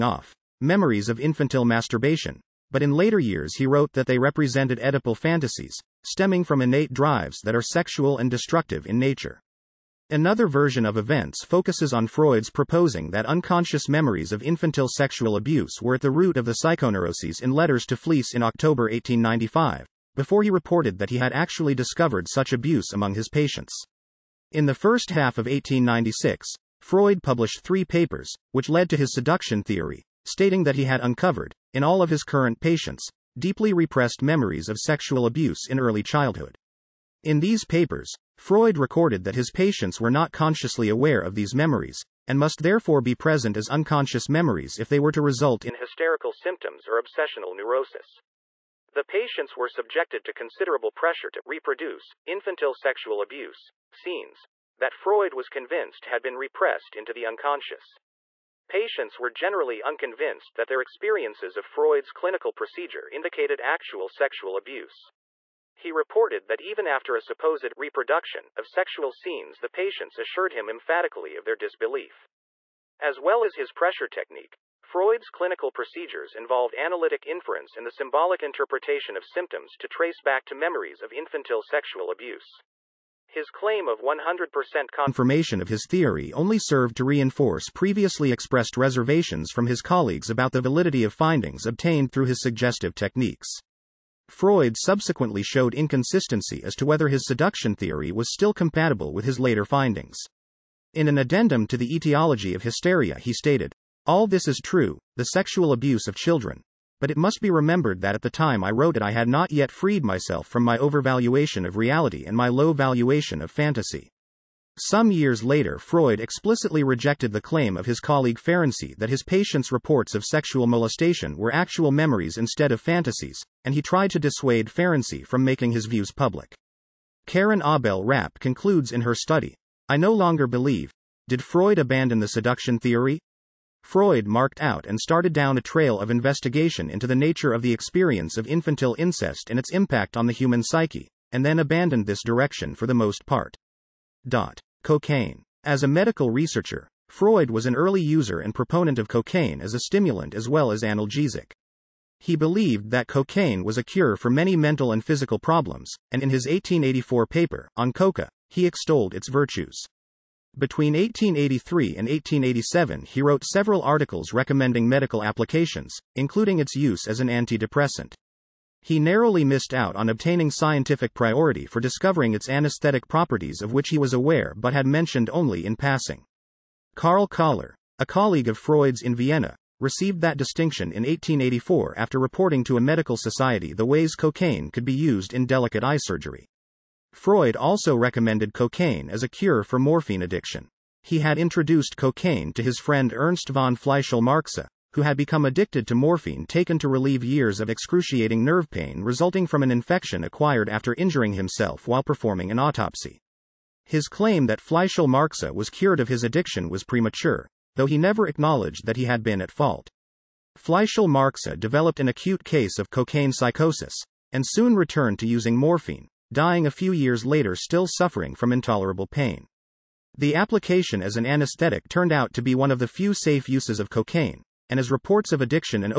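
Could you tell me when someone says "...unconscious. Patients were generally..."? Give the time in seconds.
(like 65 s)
57 s.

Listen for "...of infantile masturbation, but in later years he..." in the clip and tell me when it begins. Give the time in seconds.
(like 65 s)
1 s.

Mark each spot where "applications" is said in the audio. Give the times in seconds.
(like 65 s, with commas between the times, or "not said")
165 s, 220 s.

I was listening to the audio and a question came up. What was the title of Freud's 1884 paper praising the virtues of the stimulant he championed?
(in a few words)
On Coca.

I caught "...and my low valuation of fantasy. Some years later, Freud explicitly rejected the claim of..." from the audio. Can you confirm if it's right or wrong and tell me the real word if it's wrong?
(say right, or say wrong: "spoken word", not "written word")
right.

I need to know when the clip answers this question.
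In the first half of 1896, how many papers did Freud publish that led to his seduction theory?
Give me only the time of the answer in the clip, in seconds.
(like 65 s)
27 s.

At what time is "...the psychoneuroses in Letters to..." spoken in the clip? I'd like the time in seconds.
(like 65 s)
16 s.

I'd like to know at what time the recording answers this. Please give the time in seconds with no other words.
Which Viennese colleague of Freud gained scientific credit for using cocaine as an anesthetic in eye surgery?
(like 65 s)
176 s.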